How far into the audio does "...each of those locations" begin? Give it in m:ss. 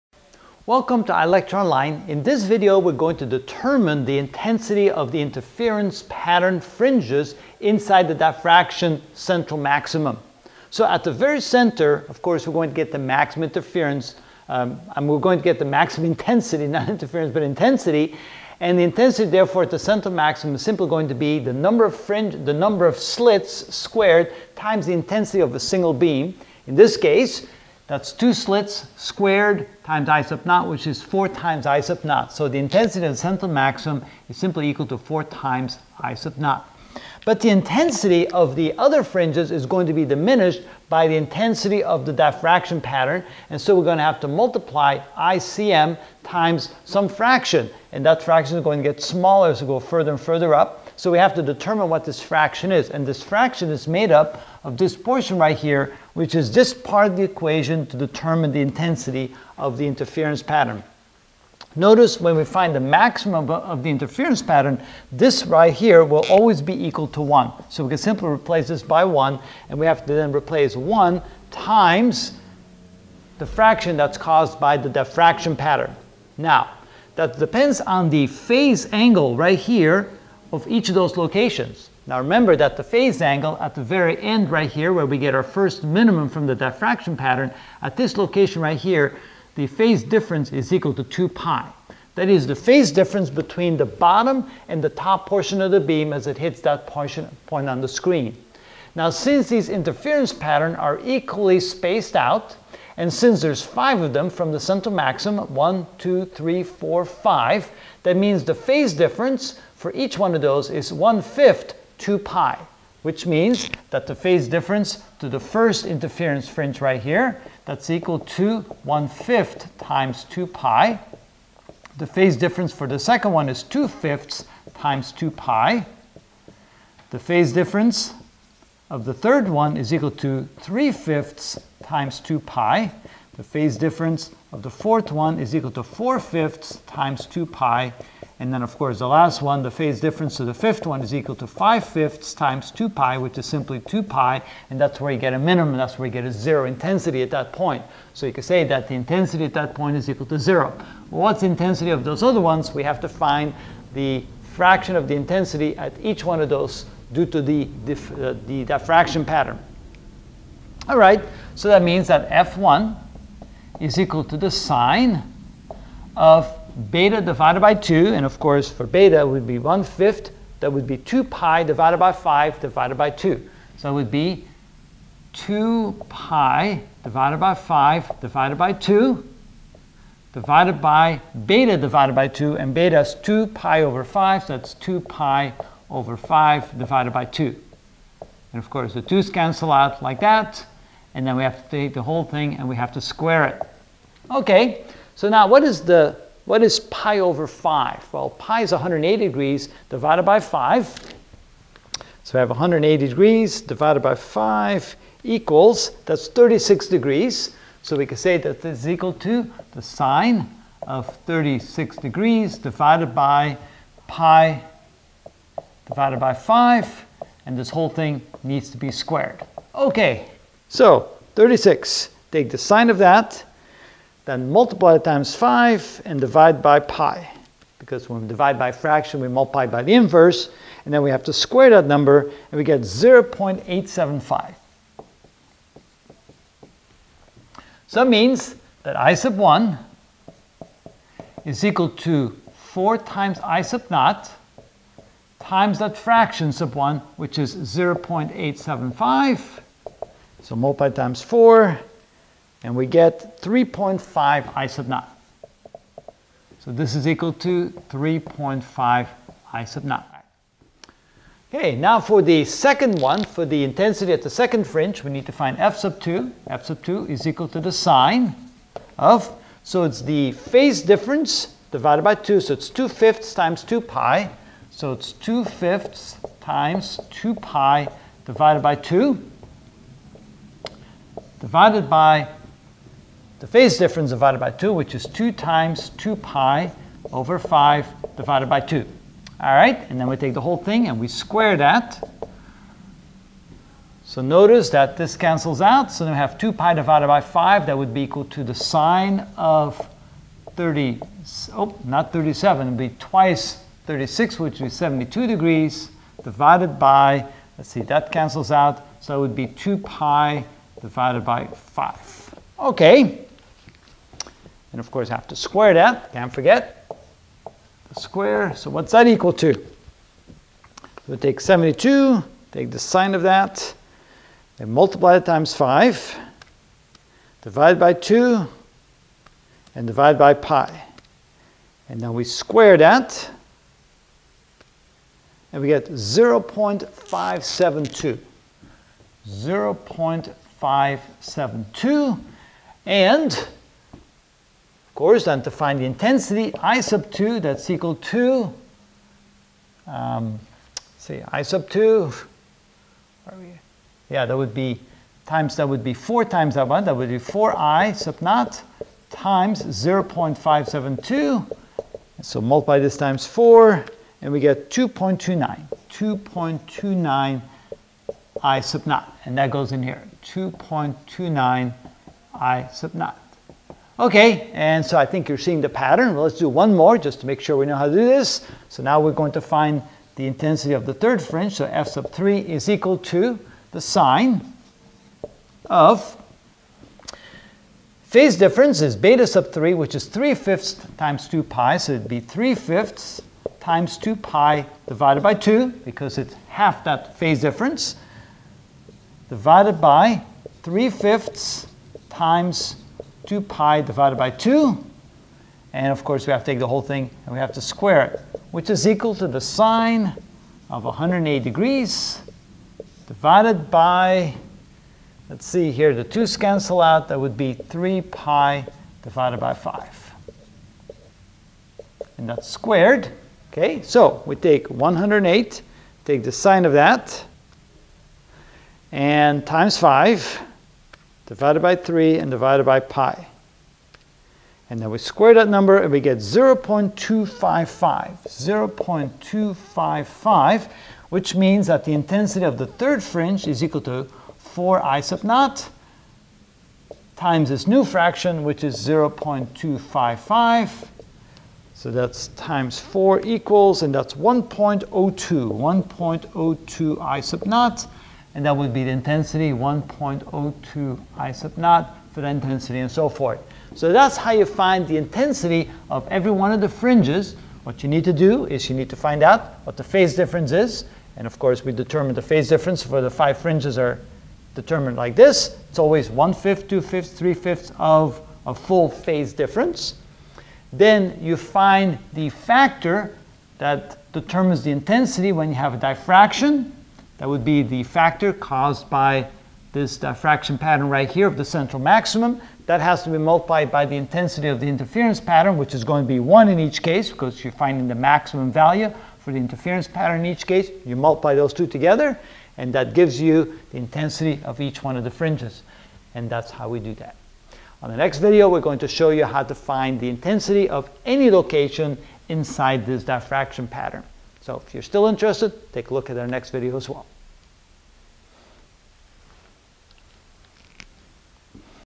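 1:20.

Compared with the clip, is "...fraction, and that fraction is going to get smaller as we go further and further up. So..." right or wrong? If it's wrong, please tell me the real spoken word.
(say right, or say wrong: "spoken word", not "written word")
right.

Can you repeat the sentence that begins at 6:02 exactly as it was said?
So multiply this times 4, and we get 2.29.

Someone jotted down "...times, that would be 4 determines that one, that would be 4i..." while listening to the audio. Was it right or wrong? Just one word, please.
wrong.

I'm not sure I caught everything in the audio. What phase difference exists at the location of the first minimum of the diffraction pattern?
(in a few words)
2 pi.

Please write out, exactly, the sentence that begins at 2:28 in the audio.
So you could say that the intensity at that point is equal to zero.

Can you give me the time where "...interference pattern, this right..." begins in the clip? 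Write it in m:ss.
1:03.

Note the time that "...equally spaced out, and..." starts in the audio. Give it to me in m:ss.
1:41.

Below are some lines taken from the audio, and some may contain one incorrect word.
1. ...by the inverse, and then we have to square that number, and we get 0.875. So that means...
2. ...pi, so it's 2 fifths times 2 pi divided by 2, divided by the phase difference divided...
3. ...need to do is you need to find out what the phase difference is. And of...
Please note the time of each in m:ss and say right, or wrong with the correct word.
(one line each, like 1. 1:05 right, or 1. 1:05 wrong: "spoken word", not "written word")
1. 3:49 right
2. 4:33 right
3. 7:47 right.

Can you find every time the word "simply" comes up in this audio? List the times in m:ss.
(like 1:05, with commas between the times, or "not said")
0:20, 0:34, 1:07, 2:23.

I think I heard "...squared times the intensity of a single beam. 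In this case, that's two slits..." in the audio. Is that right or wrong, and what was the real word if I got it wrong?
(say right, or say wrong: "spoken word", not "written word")
right.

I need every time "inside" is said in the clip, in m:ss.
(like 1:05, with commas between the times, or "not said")
0:07, 8:32.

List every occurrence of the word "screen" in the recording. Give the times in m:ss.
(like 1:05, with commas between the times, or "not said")
1:37.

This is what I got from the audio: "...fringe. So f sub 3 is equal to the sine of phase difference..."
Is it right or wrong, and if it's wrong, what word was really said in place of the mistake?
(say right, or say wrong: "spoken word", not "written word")
right.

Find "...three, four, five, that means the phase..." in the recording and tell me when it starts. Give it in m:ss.
1:46.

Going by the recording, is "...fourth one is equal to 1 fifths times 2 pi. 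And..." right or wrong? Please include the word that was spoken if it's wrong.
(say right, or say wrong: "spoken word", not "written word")
wrong: "4", not "1".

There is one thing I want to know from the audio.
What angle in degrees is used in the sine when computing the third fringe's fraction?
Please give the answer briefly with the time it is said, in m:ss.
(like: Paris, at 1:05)
108 degrees, at 6:50.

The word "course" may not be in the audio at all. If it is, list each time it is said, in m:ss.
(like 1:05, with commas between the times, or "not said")
0:12, 2:18, 2:48, 3:08, 5:14, 5:45, 6:46, 7:51.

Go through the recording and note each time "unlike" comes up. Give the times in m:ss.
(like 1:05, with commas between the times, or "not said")
not said.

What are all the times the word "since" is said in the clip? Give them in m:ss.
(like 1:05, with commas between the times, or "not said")
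1:39, 1:43.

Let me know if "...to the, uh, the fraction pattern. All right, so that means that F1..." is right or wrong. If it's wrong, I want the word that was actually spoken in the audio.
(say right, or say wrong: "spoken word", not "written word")
wrong: "diffraction", not "fraction".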